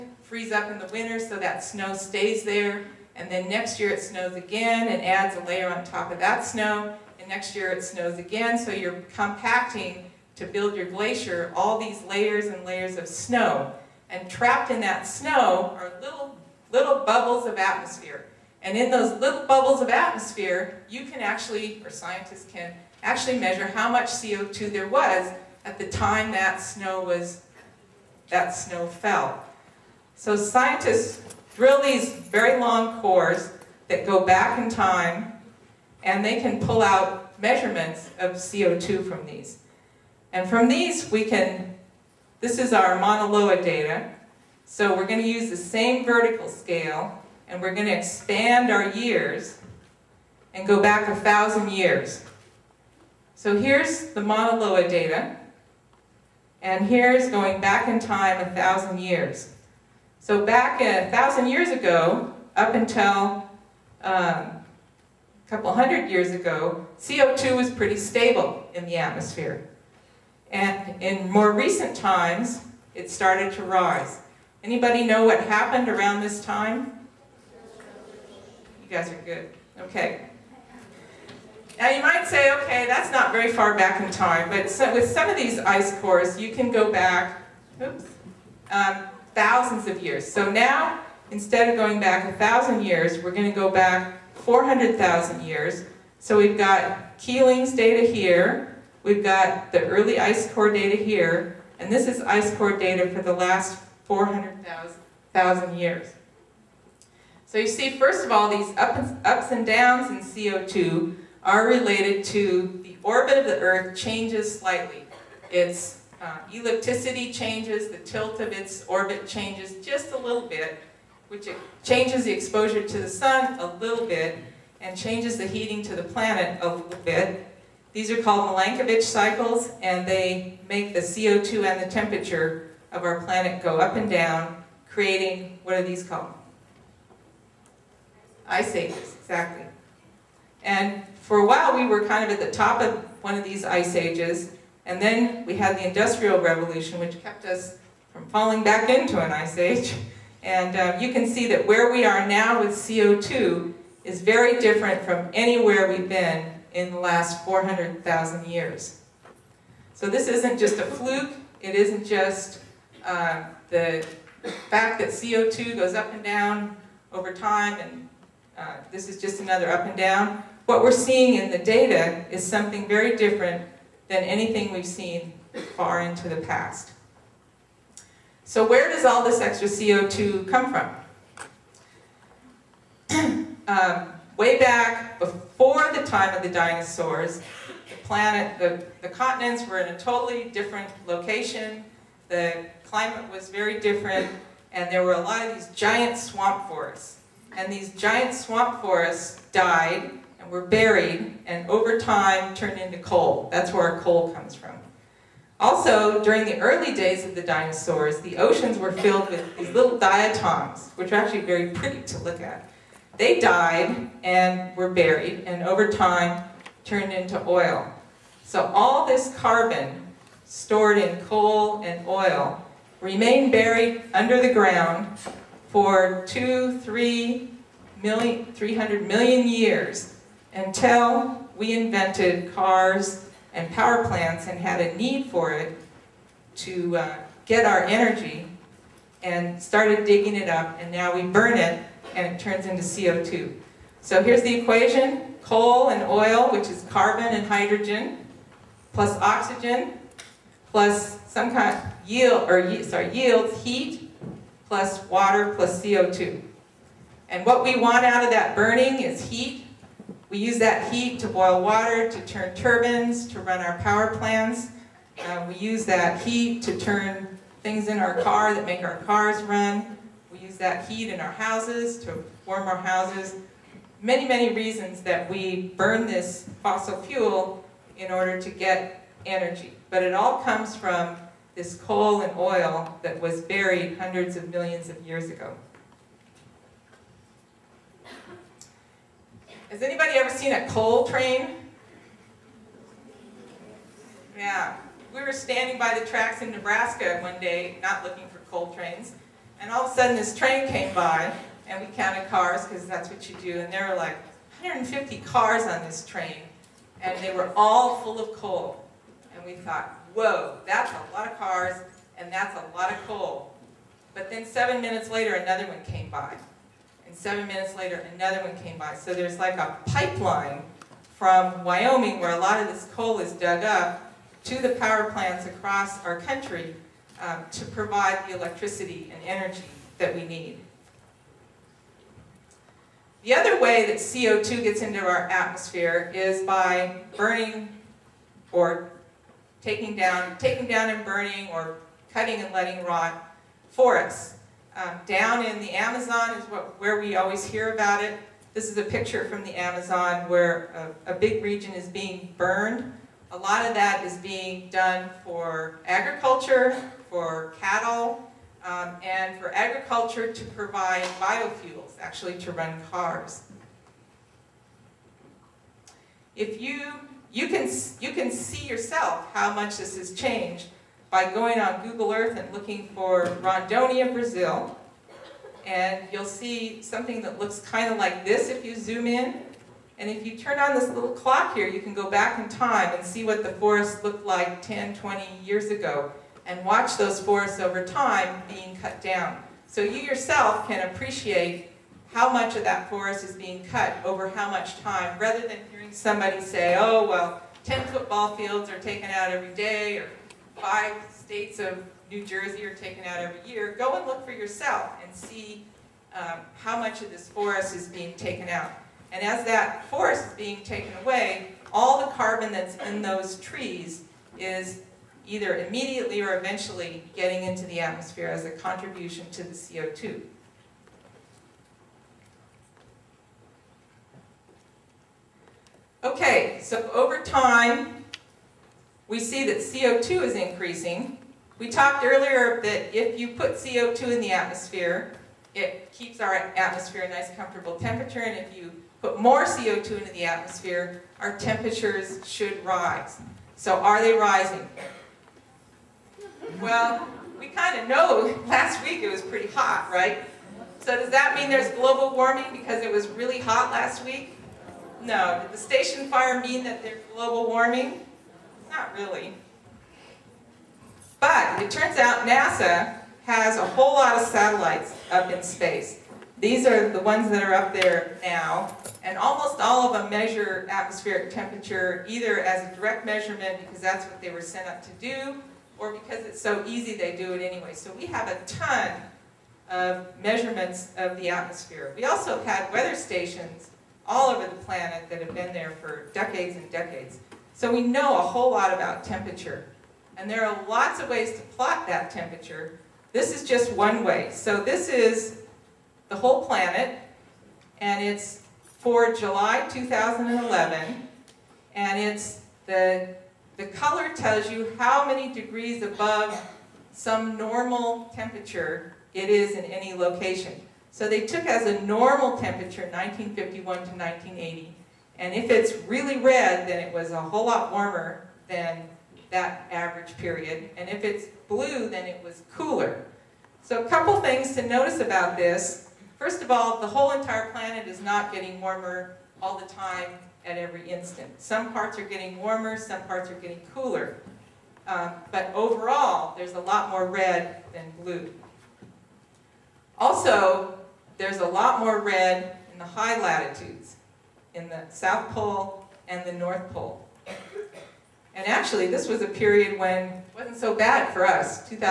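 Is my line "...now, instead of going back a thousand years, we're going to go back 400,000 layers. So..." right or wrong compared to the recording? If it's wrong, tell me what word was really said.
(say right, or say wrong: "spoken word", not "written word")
wrong: "years", not "layers".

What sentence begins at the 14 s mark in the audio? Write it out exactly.
And trapped in that snow are little, little bubbles of atmosphere.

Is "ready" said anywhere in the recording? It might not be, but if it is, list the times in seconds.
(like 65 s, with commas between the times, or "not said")
not said.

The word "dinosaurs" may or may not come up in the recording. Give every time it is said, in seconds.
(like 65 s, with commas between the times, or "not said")
186 s, 207 s.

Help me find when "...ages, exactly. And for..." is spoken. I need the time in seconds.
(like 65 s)
138 s.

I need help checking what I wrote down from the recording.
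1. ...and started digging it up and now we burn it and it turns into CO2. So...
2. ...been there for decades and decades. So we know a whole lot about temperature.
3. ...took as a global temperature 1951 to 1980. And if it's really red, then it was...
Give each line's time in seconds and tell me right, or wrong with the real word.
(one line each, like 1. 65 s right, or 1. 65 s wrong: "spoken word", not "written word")
1. 239 s right
2. 485 s right
3. 511 s wrong: "normal", not "global".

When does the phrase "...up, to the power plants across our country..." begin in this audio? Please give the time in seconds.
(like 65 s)
323 s.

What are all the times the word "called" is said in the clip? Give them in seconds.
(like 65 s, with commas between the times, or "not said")
128 s, 136 s.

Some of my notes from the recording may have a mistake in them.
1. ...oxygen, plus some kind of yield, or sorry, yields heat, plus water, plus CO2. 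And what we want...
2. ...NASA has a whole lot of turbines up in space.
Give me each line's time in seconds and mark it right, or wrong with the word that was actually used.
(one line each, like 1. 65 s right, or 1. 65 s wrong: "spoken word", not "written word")
1. 249 s right
2. 462 s wrong: "satellites", not "turbines".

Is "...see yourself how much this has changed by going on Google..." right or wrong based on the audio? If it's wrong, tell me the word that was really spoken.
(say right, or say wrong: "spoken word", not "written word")
right.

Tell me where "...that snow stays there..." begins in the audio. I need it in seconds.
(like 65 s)
1 s.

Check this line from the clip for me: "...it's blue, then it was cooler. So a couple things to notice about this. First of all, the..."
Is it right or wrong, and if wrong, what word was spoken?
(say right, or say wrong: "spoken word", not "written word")
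right.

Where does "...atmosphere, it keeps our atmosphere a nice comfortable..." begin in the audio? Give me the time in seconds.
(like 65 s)
434 s.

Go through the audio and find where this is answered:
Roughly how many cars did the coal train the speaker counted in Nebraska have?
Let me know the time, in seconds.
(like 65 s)
304 s.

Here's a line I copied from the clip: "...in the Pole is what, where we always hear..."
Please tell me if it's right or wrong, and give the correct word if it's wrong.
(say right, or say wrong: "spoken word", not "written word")
wrong: "Amazon", not "Pole".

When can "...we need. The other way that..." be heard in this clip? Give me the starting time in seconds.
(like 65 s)
330 s.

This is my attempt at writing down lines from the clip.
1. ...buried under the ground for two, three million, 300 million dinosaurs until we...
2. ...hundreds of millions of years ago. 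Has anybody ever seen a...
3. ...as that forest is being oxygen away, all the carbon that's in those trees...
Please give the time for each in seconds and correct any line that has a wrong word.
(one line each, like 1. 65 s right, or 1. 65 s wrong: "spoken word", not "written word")
1. 223 s wrong: "years", not "dinosaurs"
2. 283 s right
3. 409 s wrong: "taken", not "oxygen".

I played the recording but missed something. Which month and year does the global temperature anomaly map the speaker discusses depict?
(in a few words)
July 2011.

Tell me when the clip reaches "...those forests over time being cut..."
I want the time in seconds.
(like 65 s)
386 s.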